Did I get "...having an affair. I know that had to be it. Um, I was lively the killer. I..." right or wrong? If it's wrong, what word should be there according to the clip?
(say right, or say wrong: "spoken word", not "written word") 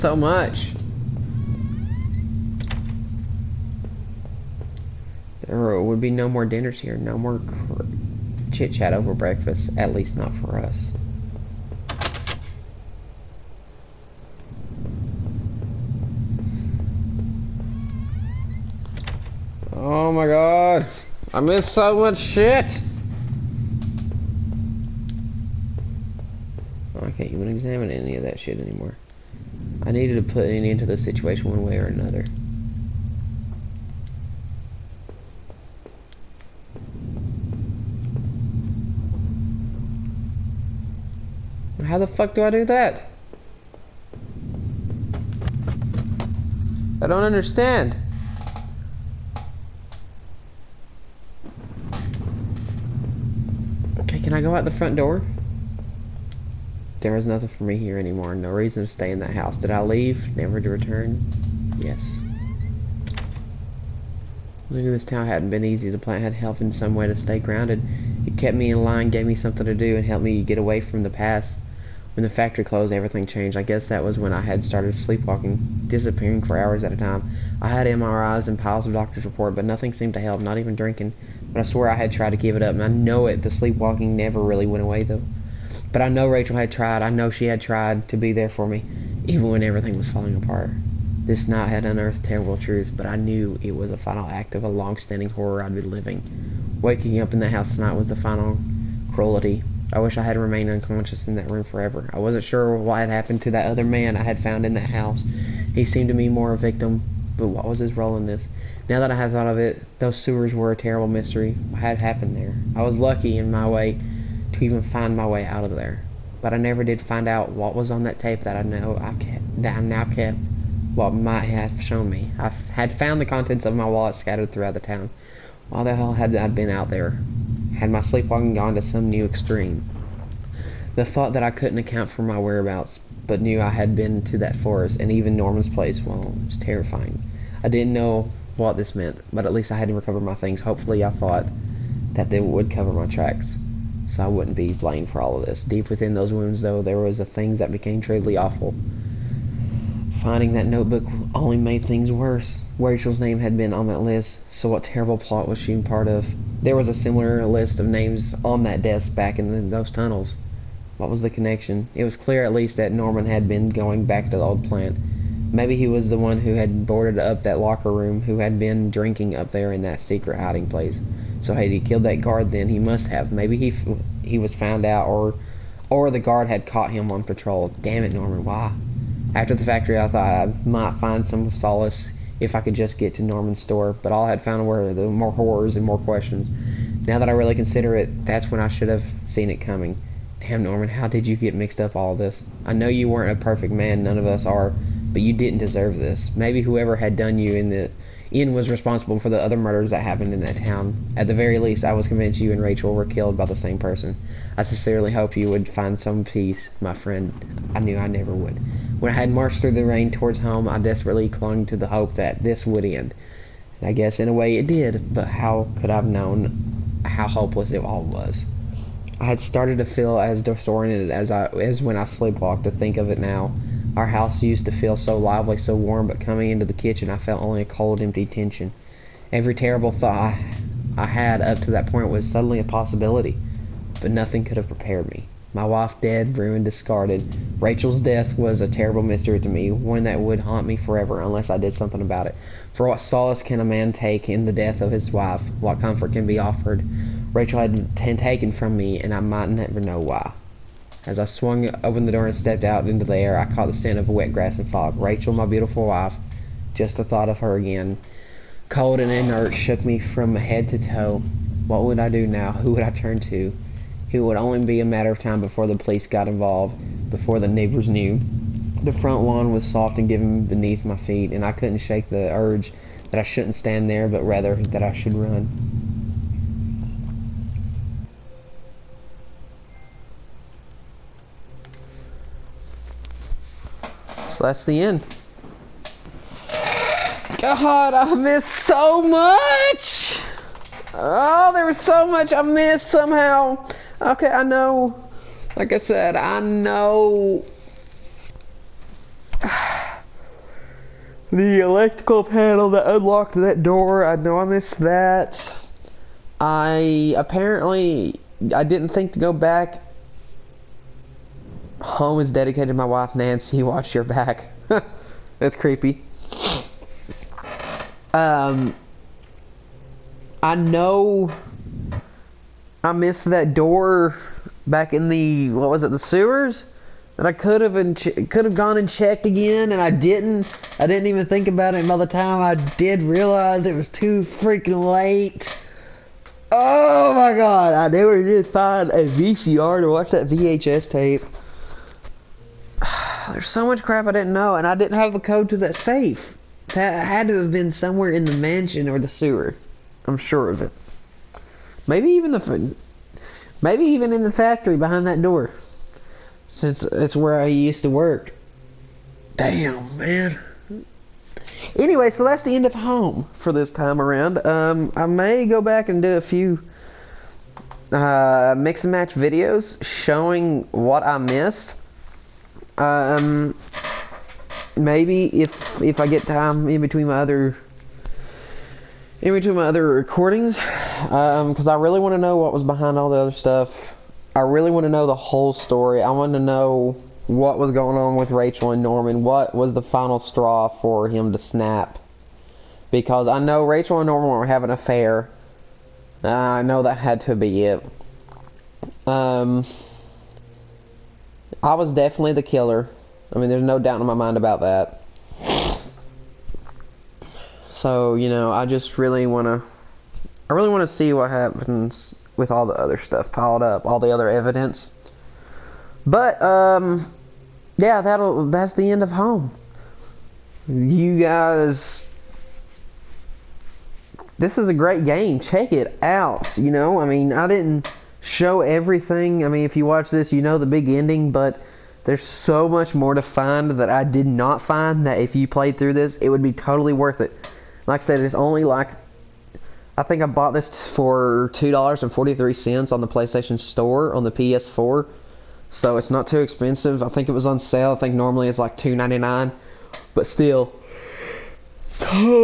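wrong: "definitely", not "lively".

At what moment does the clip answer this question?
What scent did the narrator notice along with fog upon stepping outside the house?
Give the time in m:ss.
4:14.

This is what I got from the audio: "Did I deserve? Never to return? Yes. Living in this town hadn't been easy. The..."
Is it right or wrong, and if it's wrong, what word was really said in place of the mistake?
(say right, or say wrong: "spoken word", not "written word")
wrong: "leave", not "deserve".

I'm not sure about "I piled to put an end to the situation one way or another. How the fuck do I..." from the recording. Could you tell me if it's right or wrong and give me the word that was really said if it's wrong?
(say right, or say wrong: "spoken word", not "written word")
wrong: "needed", not "piled".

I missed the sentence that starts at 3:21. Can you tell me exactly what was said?
At the very least, I was convinced you and Rachel were killed by the same person.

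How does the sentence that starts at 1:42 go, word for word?
I wasn't sure what had happened to that other man I had found in that house.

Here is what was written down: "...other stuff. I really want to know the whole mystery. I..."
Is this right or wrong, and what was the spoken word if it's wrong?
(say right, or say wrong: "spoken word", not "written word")
wrong: "story", not "mystery".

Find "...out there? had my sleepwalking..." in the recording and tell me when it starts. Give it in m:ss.
2:06.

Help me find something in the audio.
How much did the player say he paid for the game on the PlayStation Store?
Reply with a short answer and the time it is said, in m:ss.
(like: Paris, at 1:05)
$2.43, at 7:21.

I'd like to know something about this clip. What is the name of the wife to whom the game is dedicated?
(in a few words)
Nancy.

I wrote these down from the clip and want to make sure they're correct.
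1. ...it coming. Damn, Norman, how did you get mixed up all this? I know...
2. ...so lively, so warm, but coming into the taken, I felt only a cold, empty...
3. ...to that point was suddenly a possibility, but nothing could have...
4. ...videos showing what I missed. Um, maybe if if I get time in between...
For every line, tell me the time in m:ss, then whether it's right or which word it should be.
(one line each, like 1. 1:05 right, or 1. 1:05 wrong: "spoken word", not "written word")
1. 3:09 right
2. 3:44 wrong: "kitchen", not "taken"
3. 3:51 right
4. 6:09 right.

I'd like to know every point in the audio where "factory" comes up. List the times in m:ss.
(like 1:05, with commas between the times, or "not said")
1:12, 2:59, 5:54.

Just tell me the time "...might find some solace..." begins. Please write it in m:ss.
3:00.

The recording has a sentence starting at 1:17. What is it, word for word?
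I had MRIs and piles of doctor's report, but nothing seemed to help, not even drinking.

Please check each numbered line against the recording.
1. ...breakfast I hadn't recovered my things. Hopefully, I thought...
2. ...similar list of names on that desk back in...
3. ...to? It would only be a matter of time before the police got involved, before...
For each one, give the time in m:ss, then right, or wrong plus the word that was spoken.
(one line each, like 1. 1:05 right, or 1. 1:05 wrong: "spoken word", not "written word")
1. 2:19 wrong: "least", not "breakfast"
2. 2:36 right
3. 4:23 right.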